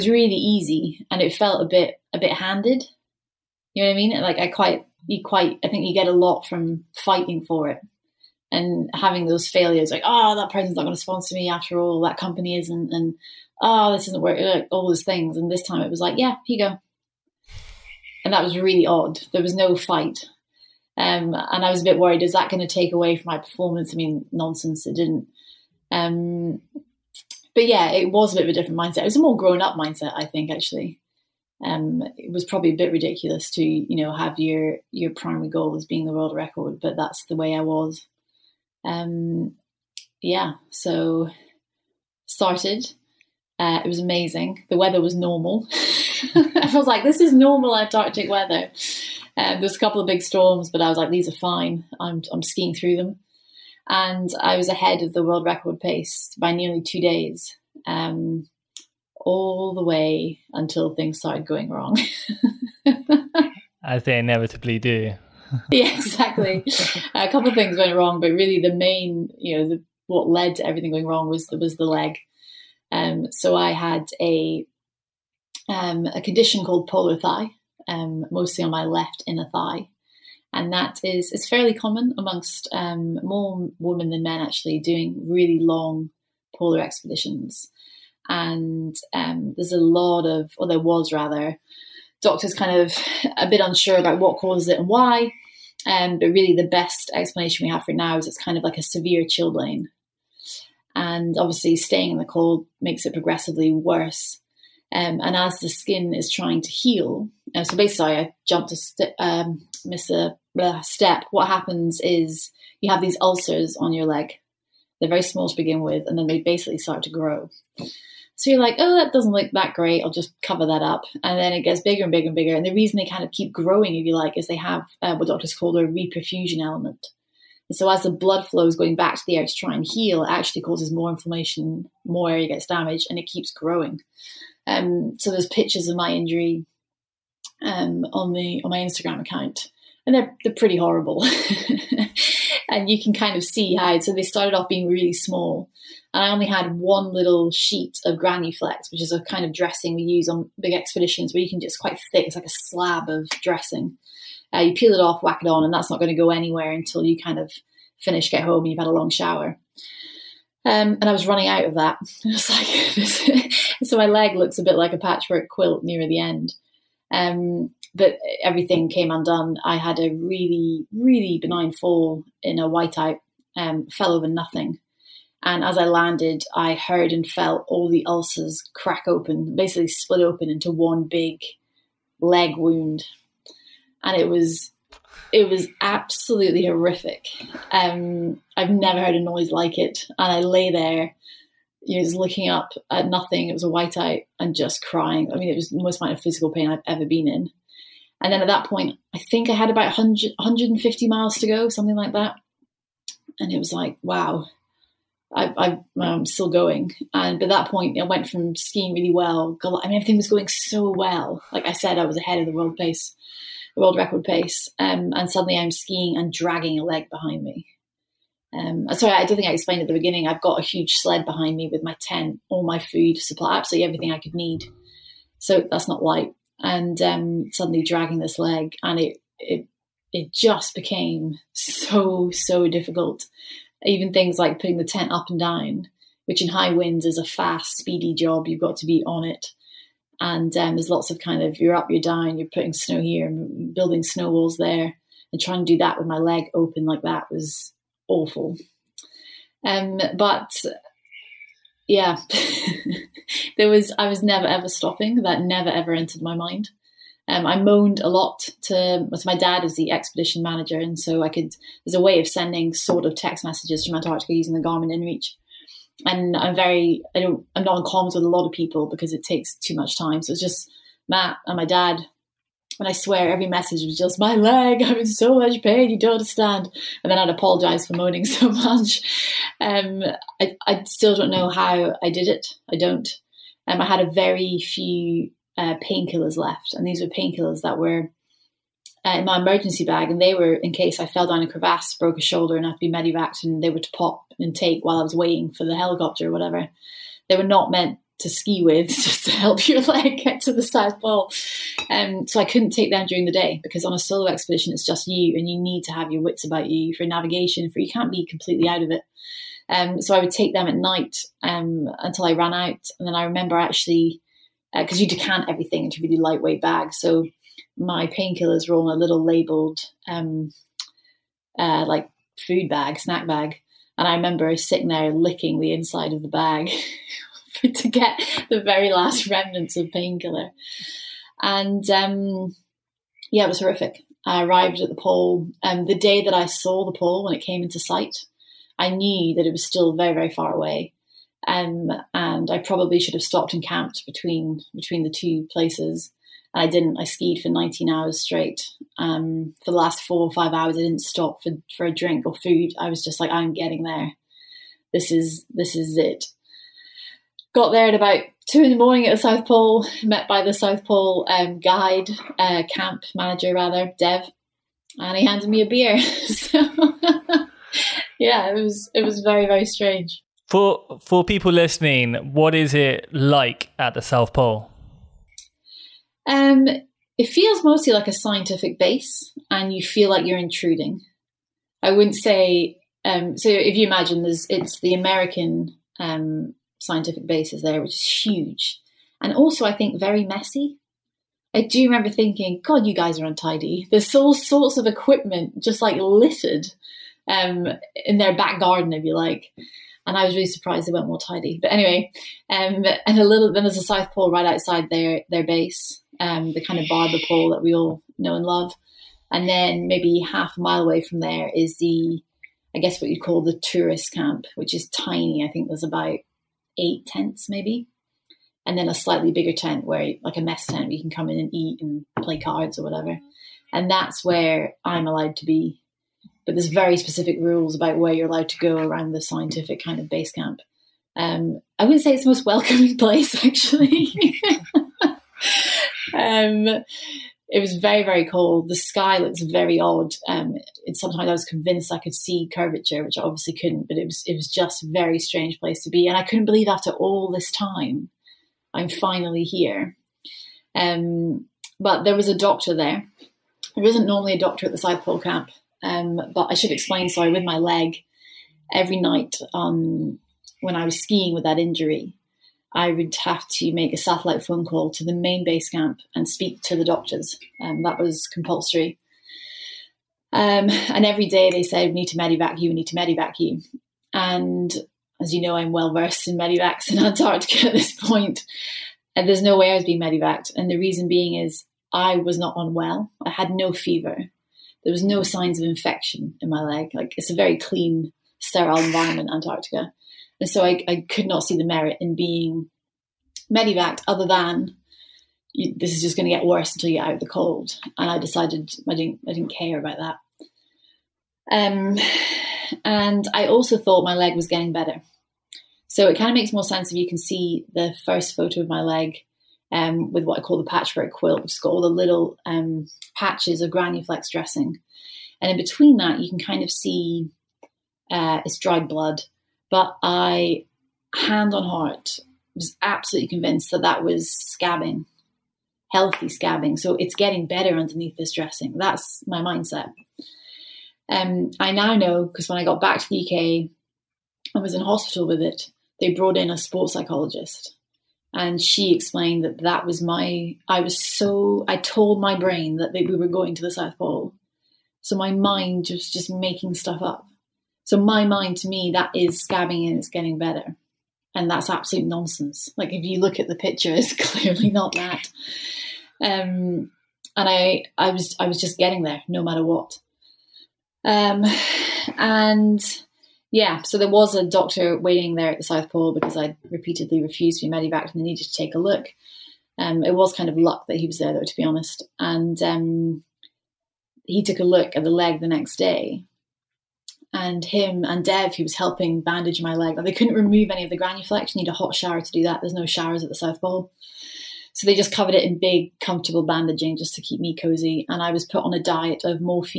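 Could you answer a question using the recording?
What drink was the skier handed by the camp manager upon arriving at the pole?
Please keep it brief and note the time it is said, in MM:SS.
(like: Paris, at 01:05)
a beer, at 06:05.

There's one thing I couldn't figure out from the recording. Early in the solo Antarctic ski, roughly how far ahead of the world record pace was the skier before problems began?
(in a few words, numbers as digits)
nearly 2 days.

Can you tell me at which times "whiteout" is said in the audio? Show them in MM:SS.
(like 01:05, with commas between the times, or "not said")
02:52, 03:13.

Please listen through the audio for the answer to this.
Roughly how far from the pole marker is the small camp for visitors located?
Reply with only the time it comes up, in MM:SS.
06:50.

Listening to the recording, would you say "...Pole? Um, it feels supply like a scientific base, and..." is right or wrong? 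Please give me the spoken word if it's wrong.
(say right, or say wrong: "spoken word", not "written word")
wrong: "mostly", not "supply".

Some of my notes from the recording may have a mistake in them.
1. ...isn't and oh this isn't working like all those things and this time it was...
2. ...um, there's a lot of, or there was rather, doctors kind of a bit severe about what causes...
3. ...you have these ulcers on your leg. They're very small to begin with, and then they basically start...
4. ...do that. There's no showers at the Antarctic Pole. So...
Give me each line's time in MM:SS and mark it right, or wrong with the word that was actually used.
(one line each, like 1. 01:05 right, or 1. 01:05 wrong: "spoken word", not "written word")
1. 00:12 right
2. 01:29 wrong: "unsure", not "severe"
3. 01:52 right
4. 09:42 wrong: "South", not "Antarctic".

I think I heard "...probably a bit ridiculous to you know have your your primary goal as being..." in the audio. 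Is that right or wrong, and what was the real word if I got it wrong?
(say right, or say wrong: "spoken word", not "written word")
right.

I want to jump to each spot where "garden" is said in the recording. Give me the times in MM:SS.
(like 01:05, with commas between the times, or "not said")
06:38.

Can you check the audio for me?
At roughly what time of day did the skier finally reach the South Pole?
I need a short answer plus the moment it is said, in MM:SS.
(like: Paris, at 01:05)
2 in the morning, at 05:58.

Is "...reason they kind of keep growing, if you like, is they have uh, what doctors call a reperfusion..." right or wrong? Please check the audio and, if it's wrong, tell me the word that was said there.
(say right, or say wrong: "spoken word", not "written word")
right.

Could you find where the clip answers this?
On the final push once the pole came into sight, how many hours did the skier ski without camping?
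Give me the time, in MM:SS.
05:47.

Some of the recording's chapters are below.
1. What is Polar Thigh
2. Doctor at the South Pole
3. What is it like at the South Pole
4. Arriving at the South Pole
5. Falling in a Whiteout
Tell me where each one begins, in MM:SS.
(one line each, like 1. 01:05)
1. 01:15
2. 09:28
3. 06:10
4. 05:46
5. 02:52.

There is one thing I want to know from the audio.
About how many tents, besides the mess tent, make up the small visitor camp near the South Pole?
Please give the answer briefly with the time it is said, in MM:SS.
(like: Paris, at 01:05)
about 8, at 06:56.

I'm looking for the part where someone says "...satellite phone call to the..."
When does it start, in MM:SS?
07:43.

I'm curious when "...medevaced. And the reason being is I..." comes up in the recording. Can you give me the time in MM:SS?
08:00.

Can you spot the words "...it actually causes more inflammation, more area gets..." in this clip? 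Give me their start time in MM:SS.
02:10.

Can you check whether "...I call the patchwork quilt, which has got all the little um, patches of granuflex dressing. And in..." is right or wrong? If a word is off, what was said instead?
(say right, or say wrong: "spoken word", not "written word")
right.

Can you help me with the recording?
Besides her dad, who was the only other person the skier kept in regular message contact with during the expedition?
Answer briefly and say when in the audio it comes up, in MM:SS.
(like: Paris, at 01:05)
Matt, at 04:31.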